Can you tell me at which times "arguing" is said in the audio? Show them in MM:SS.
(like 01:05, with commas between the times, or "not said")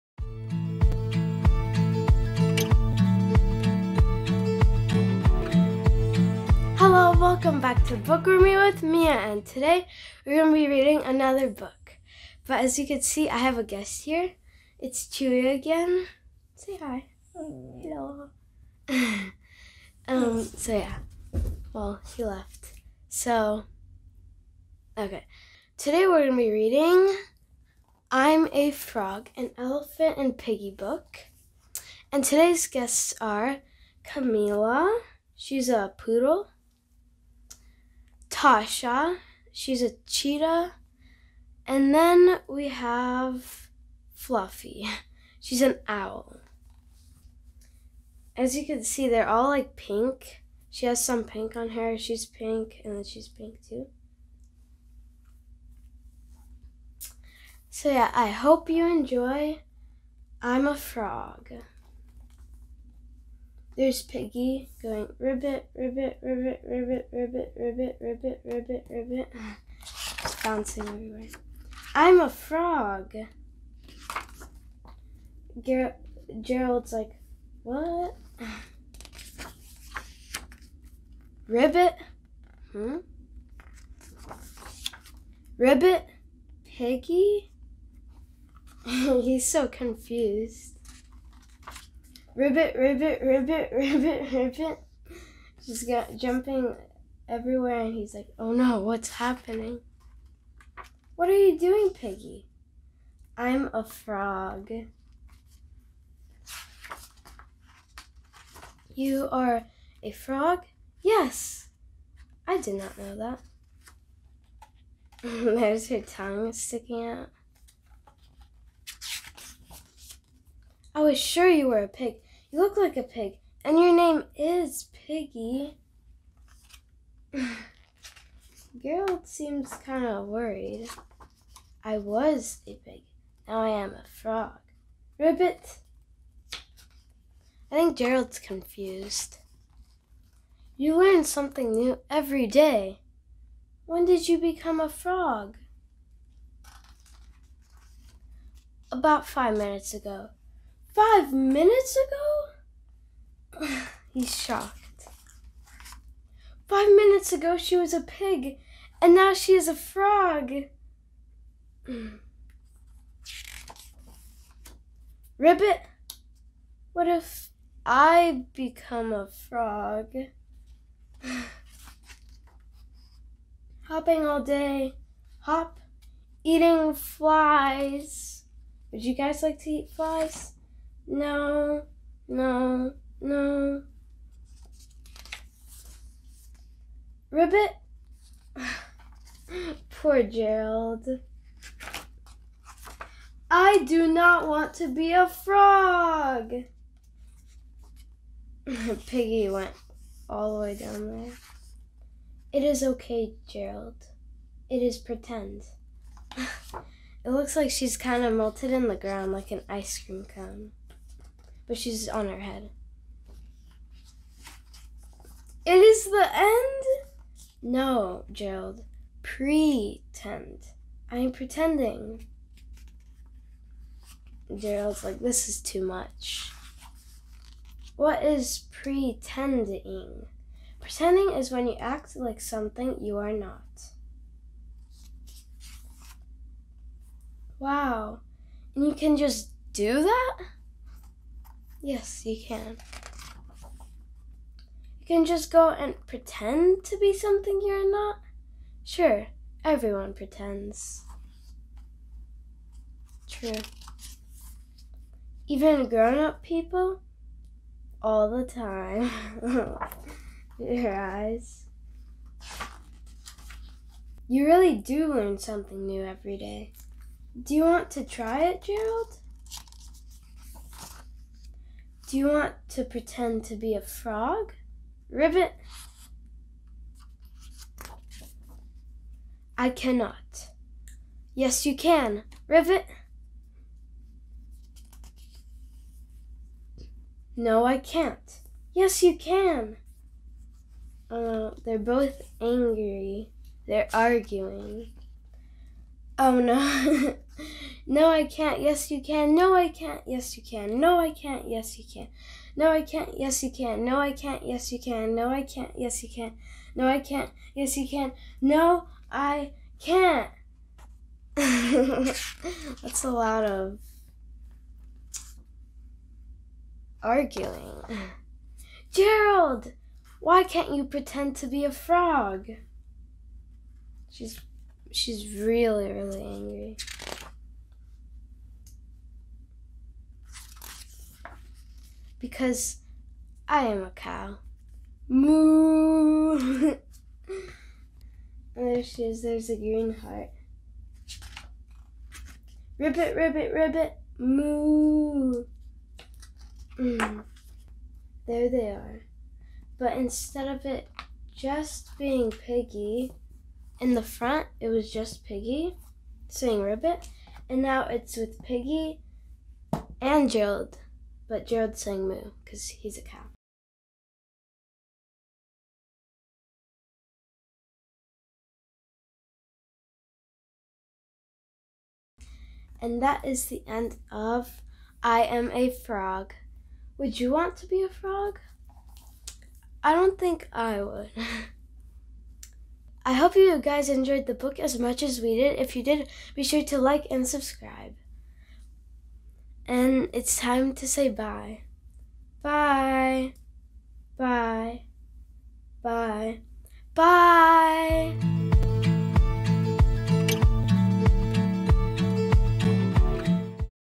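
04:53, 05:17.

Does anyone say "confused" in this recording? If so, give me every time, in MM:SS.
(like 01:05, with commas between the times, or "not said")
01:29, 02:18.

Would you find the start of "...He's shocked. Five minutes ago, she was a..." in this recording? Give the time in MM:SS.
02:34.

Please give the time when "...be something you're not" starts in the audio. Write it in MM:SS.
04:06.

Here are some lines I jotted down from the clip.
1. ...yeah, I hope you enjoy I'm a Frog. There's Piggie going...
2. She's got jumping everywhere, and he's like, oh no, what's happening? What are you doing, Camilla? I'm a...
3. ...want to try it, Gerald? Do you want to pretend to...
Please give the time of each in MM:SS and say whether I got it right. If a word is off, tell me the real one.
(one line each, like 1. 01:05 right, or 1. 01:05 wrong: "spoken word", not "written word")
1. 00:57 right
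2. 01:35 wrong: "Piggie", not "Camilla"
3. 04:27 right.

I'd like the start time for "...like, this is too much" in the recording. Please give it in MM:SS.
03:45.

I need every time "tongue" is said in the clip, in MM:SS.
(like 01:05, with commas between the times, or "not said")
01:56.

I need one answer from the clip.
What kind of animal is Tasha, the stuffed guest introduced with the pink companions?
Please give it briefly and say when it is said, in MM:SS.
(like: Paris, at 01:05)
Cheetah, at 00:40.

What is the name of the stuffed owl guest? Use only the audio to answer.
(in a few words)
Fluffy.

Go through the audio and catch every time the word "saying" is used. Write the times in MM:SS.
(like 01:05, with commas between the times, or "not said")
05:56, 06:01.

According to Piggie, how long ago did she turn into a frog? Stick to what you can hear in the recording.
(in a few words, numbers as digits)
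5 minutes ago.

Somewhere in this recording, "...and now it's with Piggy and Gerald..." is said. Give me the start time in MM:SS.
05:57.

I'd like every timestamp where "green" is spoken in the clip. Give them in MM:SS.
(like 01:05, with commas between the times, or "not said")
05:39.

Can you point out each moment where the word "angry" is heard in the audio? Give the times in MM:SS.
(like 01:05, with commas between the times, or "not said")
04:52, 05:26.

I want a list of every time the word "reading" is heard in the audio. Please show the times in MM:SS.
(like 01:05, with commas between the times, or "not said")
00:10, 00:26.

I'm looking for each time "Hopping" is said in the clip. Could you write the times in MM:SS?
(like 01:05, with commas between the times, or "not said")
02:53.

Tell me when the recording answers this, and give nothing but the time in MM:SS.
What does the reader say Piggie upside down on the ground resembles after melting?
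03:29.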